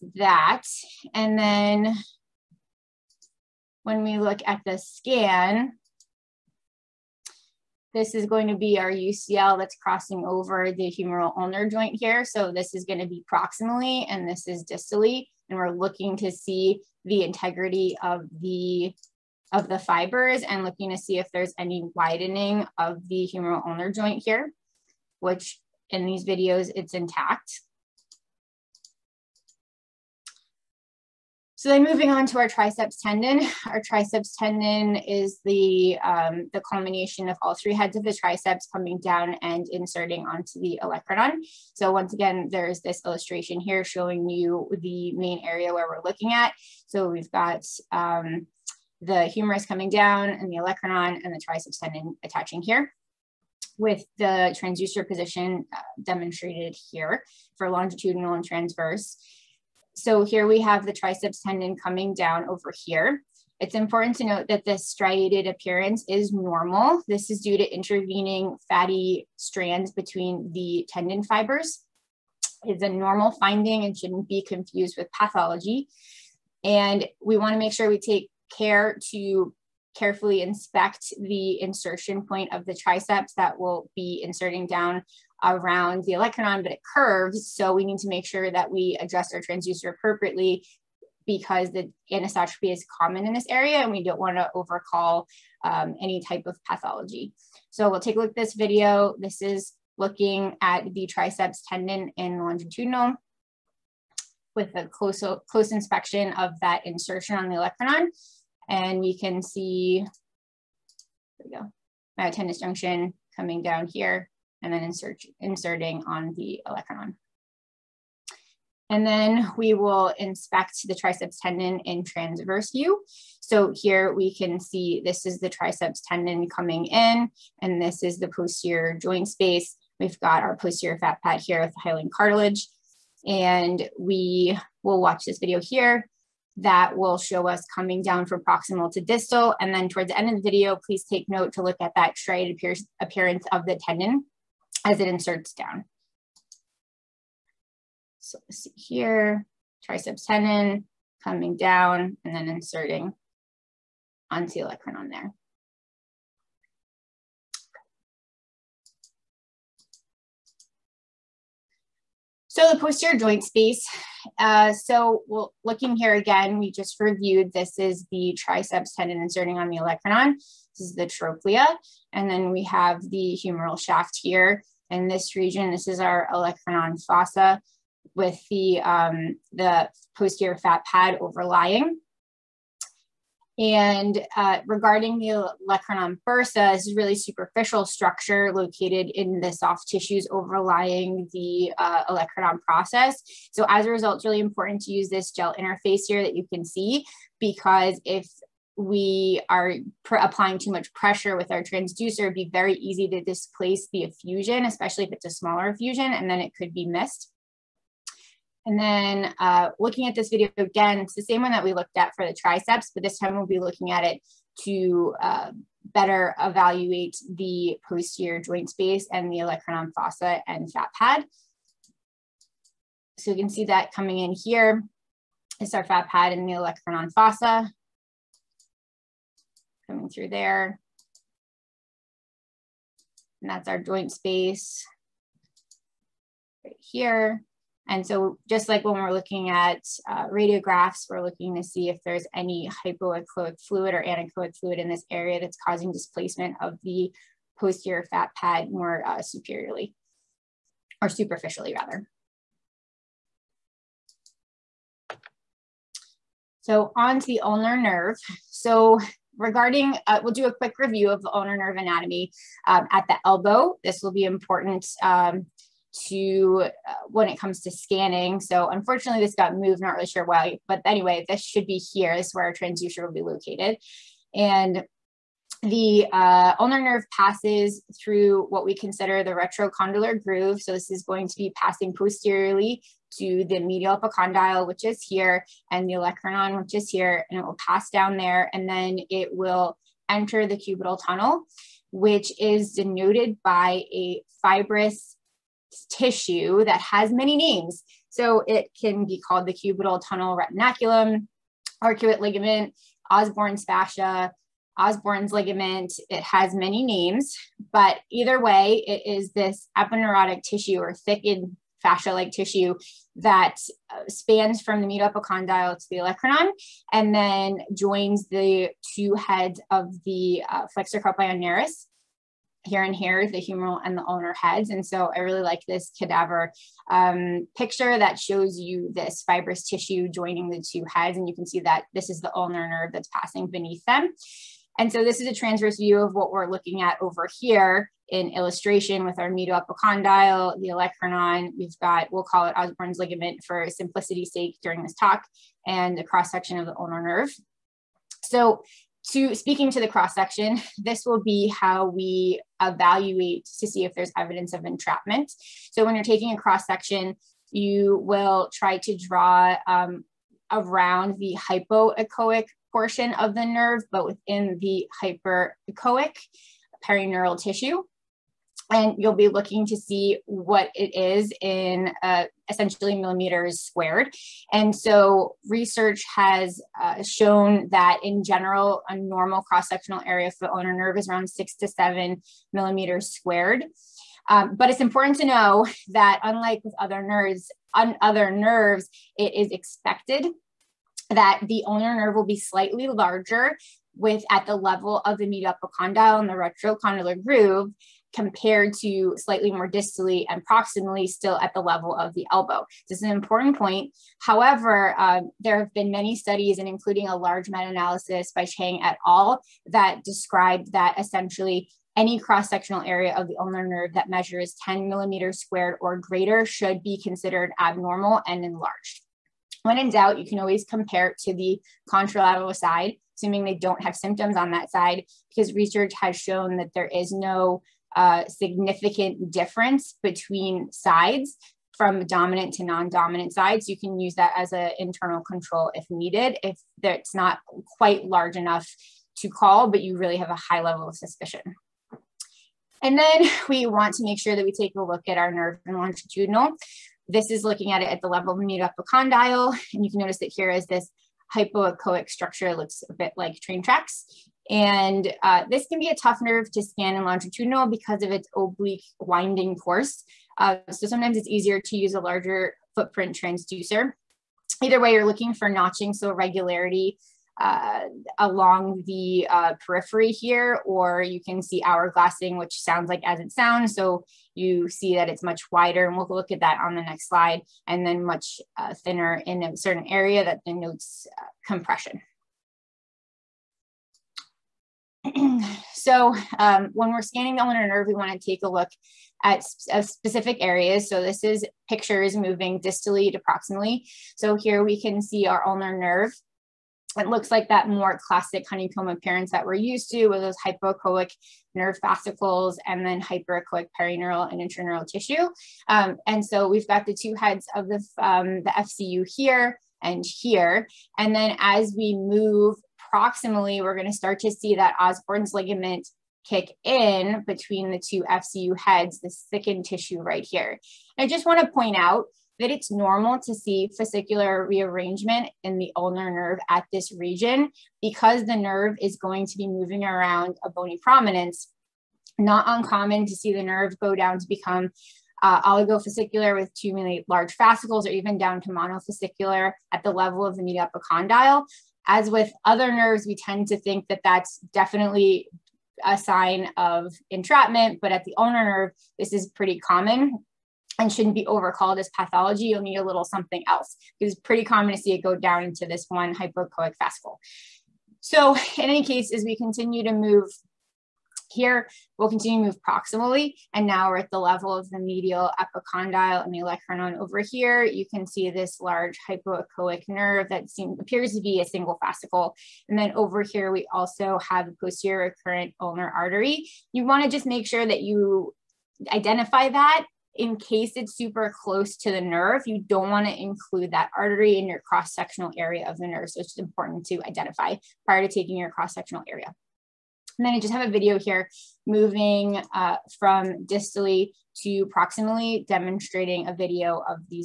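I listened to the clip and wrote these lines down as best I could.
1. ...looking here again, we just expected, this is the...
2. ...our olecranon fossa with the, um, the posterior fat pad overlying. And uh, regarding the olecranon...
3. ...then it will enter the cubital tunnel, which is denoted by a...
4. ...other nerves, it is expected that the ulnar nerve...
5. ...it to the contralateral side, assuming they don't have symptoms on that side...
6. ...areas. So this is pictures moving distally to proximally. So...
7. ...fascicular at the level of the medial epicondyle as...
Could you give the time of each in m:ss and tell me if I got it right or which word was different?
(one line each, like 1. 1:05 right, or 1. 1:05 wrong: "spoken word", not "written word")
1. 2:45 wrong: "reviewed", not "expected"
2. 2:56 right
3. 4:48 right
4. 6:28 right
5. 7:01 right
6. 8:10 right
7. 8:58 wrong: "monofascicular", not "fascicular".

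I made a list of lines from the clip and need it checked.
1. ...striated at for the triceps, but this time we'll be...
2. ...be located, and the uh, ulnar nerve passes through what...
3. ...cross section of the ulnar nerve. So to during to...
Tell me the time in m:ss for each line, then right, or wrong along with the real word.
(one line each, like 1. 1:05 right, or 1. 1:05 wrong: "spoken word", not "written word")
1. 3:31 wrong: "looked", not "striated"
2. 4:33 right
3. 5:46 wrong: "speaking", not "during".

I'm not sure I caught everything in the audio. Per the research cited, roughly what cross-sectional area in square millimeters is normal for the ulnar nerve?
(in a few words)
6 to 7.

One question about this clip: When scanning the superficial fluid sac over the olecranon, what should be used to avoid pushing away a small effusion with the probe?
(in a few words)
Gel interface.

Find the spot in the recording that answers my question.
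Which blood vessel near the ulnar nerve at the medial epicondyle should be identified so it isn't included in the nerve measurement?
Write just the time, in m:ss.
9:34.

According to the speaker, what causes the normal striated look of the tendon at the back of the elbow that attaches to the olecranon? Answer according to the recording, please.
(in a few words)
Intervening fatty strands.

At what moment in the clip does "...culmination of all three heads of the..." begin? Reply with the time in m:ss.
0:36.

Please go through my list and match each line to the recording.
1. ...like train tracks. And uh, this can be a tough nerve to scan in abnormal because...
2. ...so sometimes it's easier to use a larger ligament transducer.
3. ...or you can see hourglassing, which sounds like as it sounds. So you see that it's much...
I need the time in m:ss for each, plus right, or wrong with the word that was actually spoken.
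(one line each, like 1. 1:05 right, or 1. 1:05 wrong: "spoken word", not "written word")
1. 7:33 wrong: "longitudinal", not "abnormal"
2. 7:40 wrong: "footprint", not "ligament"
3. 7:50 right.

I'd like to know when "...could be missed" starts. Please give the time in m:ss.
3:26.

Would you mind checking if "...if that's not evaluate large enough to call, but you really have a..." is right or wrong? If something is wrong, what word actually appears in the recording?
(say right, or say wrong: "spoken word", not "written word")
wrong: "quite", not "evaluate".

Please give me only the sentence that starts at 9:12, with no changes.
You'll need a little something else.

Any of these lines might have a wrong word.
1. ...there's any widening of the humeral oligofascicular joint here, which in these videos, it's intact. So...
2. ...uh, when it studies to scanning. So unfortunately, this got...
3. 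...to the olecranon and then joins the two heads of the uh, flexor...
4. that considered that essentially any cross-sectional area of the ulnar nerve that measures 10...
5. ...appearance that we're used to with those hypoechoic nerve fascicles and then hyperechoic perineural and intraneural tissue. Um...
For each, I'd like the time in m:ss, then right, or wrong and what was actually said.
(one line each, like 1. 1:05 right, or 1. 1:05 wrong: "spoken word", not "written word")
1. 0:21 wrong: "ulnar", not "oligofascicular"
2. 4:26 wrong: "comes", not "studies"
3. 5:15 right
4. 6:49 wrong: "described", not "considered"
5. 8:18 right.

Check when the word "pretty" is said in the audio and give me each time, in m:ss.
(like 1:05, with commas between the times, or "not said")
9:09, 9:14.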